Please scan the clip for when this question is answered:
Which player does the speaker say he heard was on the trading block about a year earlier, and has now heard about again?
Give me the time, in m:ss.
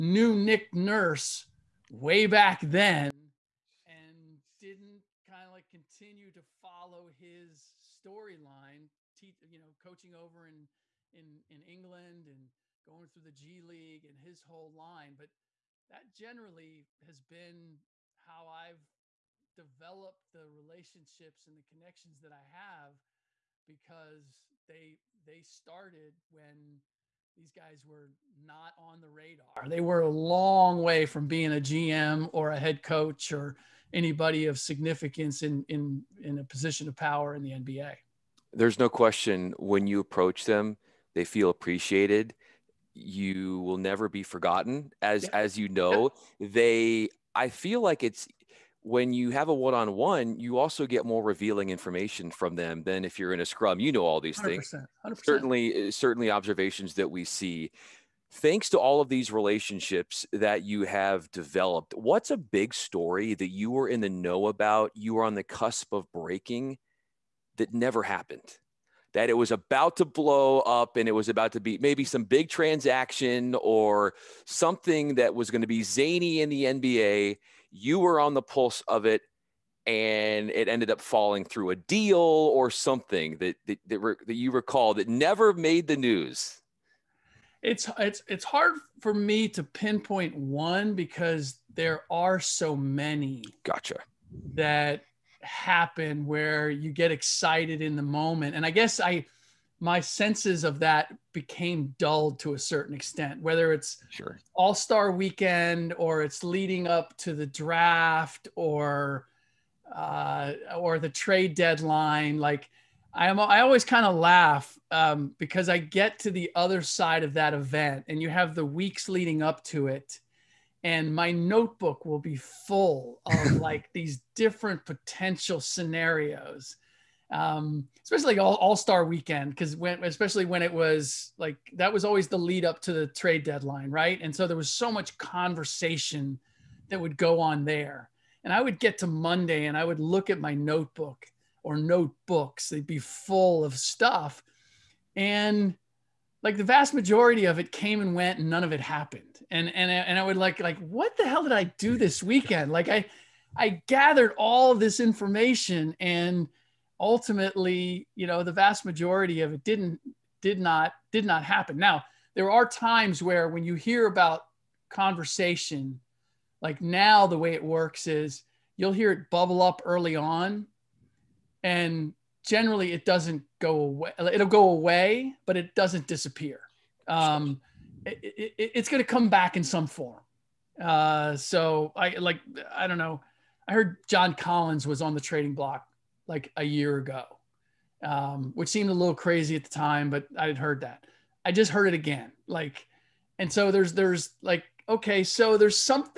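3:04.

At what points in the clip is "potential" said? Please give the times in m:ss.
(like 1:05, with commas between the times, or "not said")
2:04.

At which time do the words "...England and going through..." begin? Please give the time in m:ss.
0:11.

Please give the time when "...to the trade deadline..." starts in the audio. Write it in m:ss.
2:12.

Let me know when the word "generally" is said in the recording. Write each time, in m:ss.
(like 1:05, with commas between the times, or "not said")
0:16, 2:52.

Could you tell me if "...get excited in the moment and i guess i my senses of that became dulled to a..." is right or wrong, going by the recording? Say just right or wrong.
right.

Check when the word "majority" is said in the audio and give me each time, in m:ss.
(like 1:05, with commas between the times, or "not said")
2:26, 2:38.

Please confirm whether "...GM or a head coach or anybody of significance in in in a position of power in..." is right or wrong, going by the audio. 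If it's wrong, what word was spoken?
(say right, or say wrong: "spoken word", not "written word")
right.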